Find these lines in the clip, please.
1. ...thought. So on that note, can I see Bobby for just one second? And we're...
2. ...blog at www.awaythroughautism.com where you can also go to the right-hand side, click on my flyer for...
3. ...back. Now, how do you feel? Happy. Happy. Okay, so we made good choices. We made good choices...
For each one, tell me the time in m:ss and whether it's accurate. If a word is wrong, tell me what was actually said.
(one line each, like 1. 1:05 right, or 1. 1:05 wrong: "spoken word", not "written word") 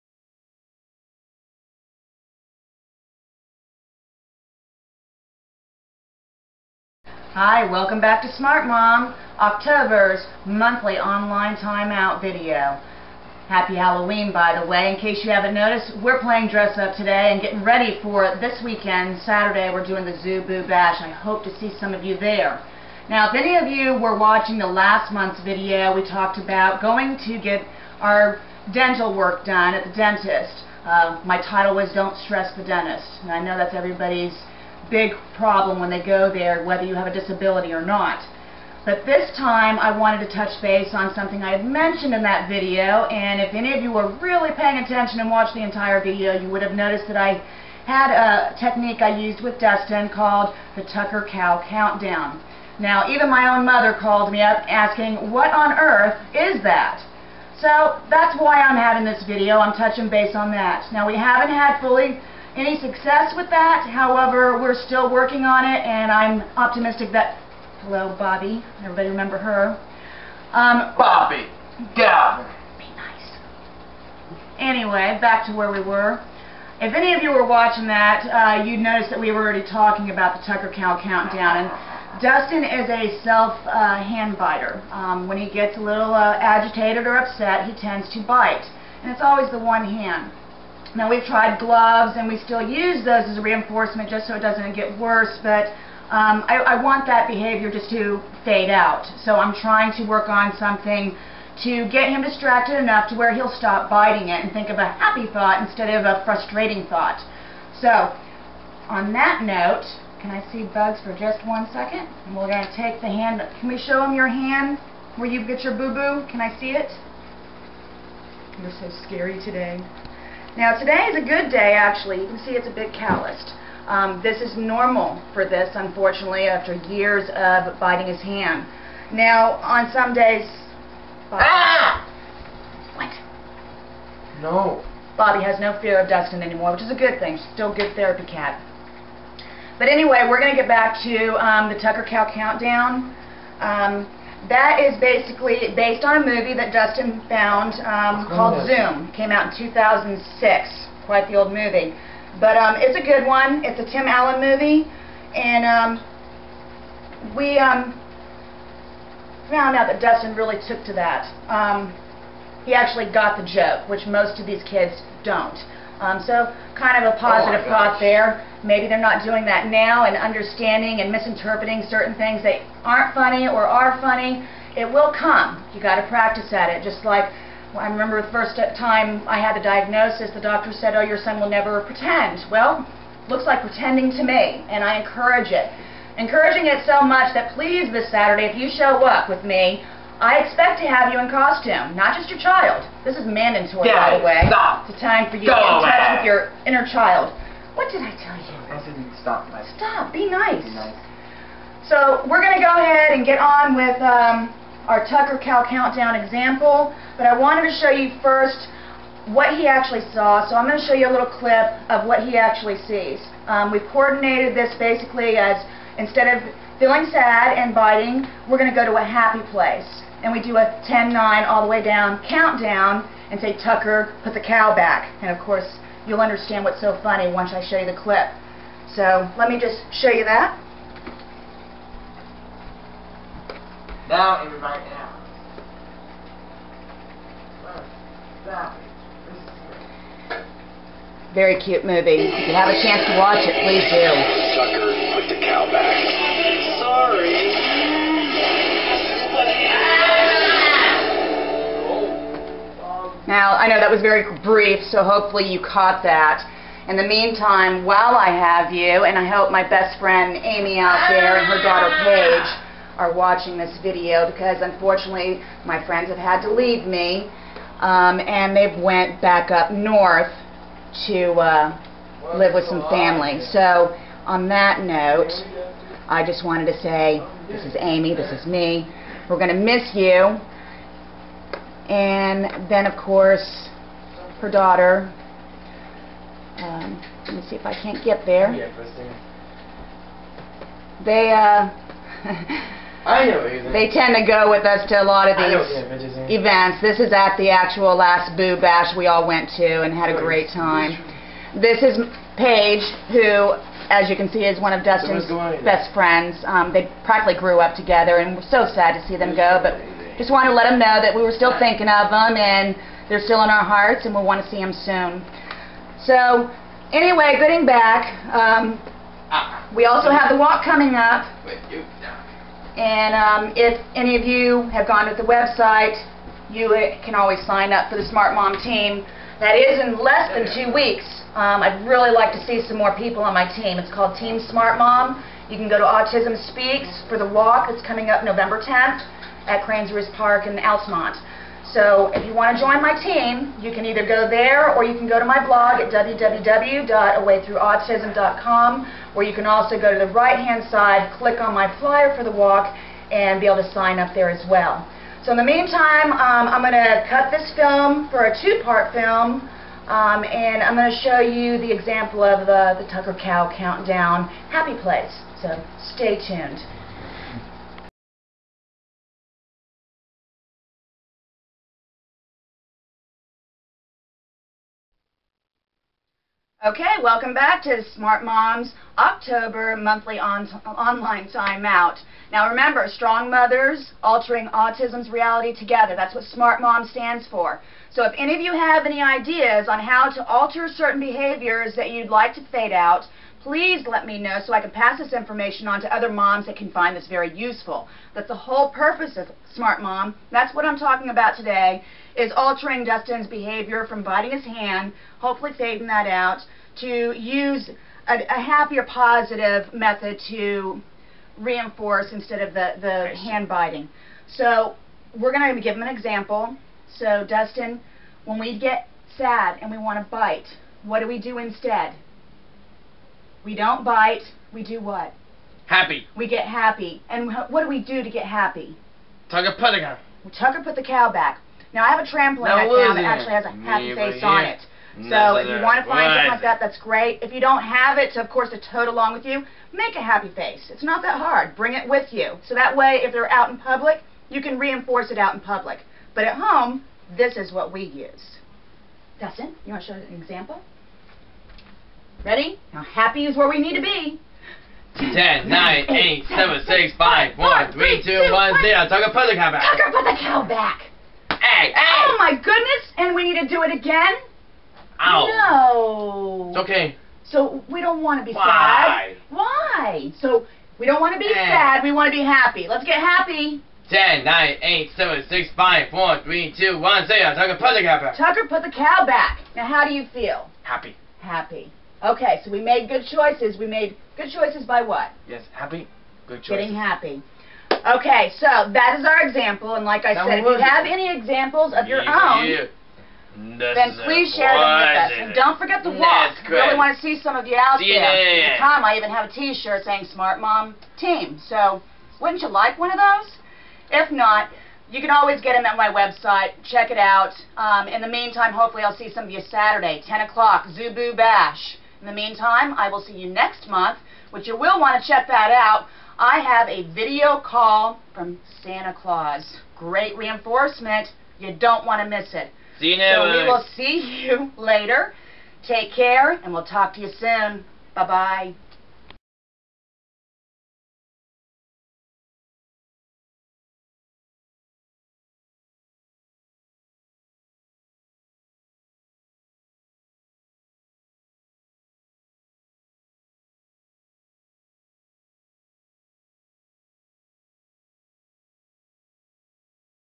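1. 1:46 wrong: "Bugs", not "Bobby"
2. 5:45 right
3. 7:59 right.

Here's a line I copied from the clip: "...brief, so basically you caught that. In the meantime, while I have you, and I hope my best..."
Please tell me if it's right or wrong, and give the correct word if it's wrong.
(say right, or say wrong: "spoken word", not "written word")
wrong: "hopefully", not "basically".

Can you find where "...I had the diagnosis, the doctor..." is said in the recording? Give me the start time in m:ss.
2:59.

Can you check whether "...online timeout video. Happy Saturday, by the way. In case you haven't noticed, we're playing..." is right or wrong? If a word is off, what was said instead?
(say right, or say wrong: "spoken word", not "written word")
wrong: "Halloween", not "Saturday".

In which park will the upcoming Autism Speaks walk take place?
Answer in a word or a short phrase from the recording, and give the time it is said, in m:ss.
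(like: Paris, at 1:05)
Cranes Park, at 5:39.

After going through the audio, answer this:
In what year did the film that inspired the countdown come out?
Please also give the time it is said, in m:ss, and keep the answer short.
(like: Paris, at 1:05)
2006, at 2:29.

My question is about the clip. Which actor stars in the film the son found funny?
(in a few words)
Tim Allen.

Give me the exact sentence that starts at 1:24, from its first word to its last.
Um, when he gets a little uh, agitated or upset, he tends to bite, and it's always the one hand.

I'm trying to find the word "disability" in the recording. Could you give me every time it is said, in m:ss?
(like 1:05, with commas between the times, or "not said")
0:37.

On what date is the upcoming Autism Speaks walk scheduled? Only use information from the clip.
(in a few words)
November 10th.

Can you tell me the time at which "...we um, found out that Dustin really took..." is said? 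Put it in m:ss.
2:37.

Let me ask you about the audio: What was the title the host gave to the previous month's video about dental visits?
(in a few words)
Don't Stress the Dentist.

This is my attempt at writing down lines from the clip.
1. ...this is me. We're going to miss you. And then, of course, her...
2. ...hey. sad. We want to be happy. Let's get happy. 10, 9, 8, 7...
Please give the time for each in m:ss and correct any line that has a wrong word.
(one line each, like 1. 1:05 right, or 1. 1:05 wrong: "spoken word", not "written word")
1. 4:38 right
2. 7:51 right.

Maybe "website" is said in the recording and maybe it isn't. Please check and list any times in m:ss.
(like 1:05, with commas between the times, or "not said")
5:25, 8:25.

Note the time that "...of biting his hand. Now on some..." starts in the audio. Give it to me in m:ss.
2:07.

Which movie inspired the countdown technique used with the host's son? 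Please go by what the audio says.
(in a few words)
Zoom.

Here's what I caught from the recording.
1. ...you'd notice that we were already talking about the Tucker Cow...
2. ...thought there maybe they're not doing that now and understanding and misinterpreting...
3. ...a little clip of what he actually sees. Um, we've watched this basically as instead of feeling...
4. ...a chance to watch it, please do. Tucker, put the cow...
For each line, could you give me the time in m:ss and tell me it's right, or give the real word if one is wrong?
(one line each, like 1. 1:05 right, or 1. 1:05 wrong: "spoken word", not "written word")
1. 1:18 right
2. 2:47 right
3. 3:31 wrong: "coordinated", not "watched"
4. 4:02 right.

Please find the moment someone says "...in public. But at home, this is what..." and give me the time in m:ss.
7:25.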